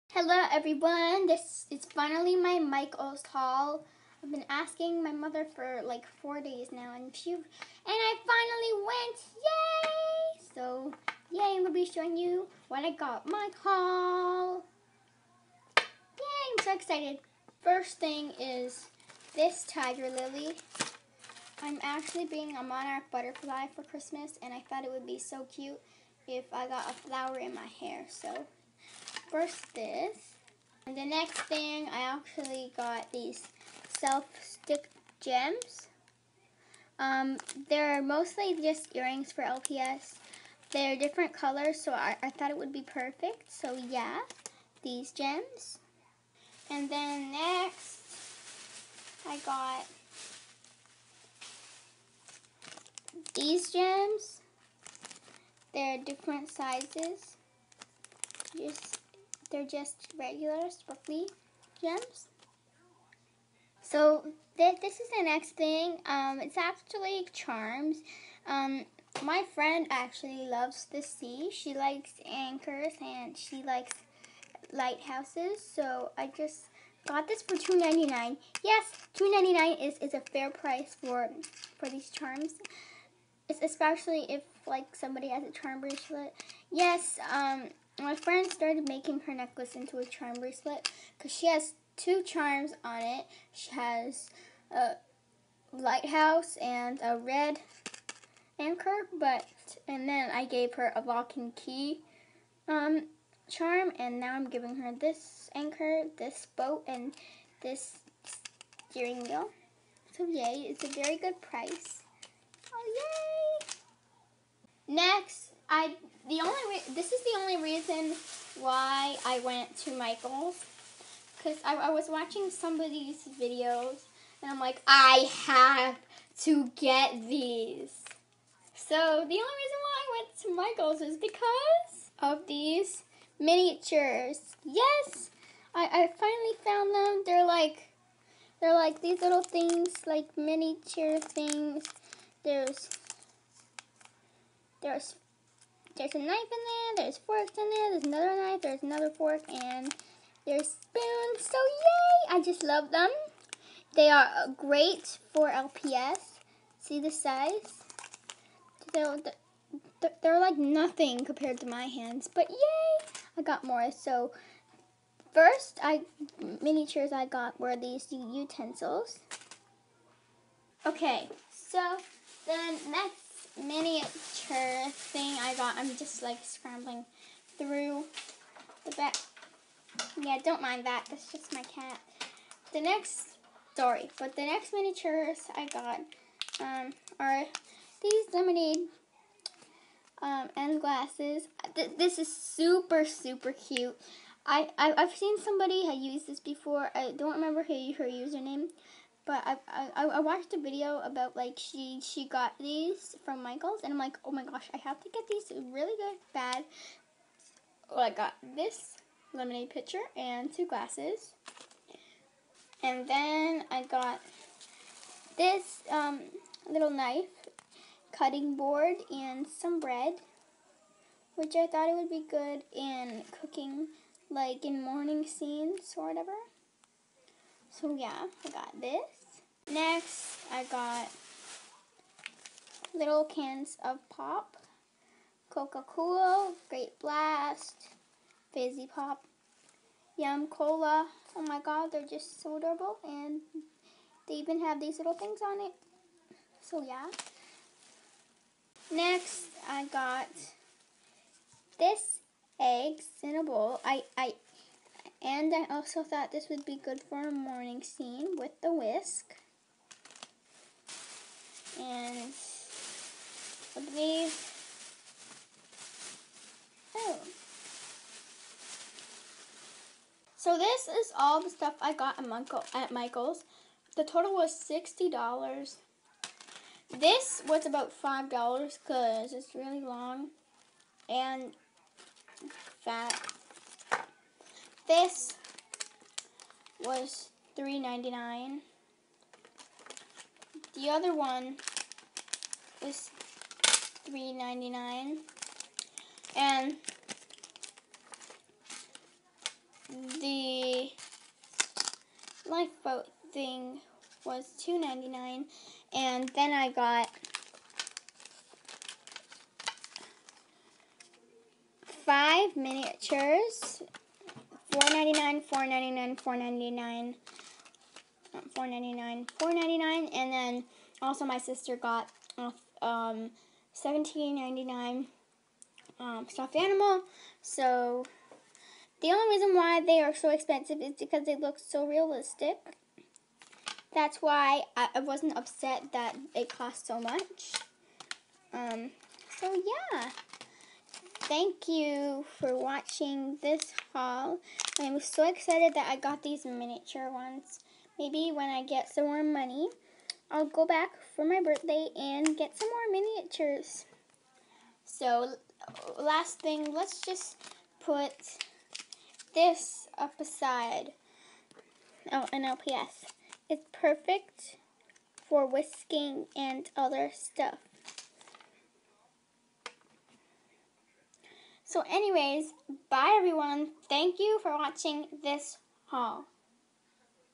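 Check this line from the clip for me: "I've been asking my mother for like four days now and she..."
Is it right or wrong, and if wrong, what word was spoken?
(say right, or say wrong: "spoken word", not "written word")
right.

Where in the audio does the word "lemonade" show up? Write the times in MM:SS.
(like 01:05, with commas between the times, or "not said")
03:08, 03:29.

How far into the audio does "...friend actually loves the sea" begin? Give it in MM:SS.
01:09.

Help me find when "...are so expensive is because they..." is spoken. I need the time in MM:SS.
05:29.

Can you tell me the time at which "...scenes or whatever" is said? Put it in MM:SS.
03:45.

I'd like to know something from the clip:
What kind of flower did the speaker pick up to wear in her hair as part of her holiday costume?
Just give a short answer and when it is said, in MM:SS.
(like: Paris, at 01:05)
Tiger lily, at 00:19.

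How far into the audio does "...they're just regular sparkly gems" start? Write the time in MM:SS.
00:59.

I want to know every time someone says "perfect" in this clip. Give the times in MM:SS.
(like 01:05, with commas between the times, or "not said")
00:42, 06:03.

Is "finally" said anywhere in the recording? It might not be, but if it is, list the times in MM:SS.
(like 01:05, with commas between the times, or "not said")
00:01, 00:08, 02:16.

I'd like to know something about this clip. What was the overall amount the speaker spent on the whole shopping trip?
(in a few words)
$60.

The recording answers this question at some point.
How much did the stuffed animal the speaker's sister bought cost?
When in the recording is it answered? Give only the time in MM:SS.
05:23.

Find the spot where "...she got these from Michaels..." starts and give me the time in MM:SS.
03:22.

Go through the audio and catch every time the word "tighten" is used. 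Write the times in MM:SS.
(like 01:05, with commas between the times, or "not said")
not said.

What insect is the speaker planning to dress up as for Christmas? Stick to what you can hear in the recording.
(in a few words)
Monarch butterfly.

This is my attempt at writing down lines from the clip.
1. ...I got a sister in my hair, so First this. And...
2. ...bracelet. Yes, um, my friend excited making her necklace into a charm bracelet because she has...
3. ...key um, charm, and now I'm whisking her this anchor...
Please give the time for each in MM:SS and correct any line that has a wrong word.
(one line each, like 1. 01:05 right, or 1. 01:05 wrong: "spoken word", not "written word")
1. 00:26 wrong: "flower", not "sister"
2. 01:25 wrong: "started", not "excited"
3. 01:41 wrong: "giving", not "whisking".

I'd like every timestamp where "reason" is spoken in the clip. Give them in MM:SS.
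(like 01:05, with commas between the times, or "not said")
01:57, 02:09, 05:29.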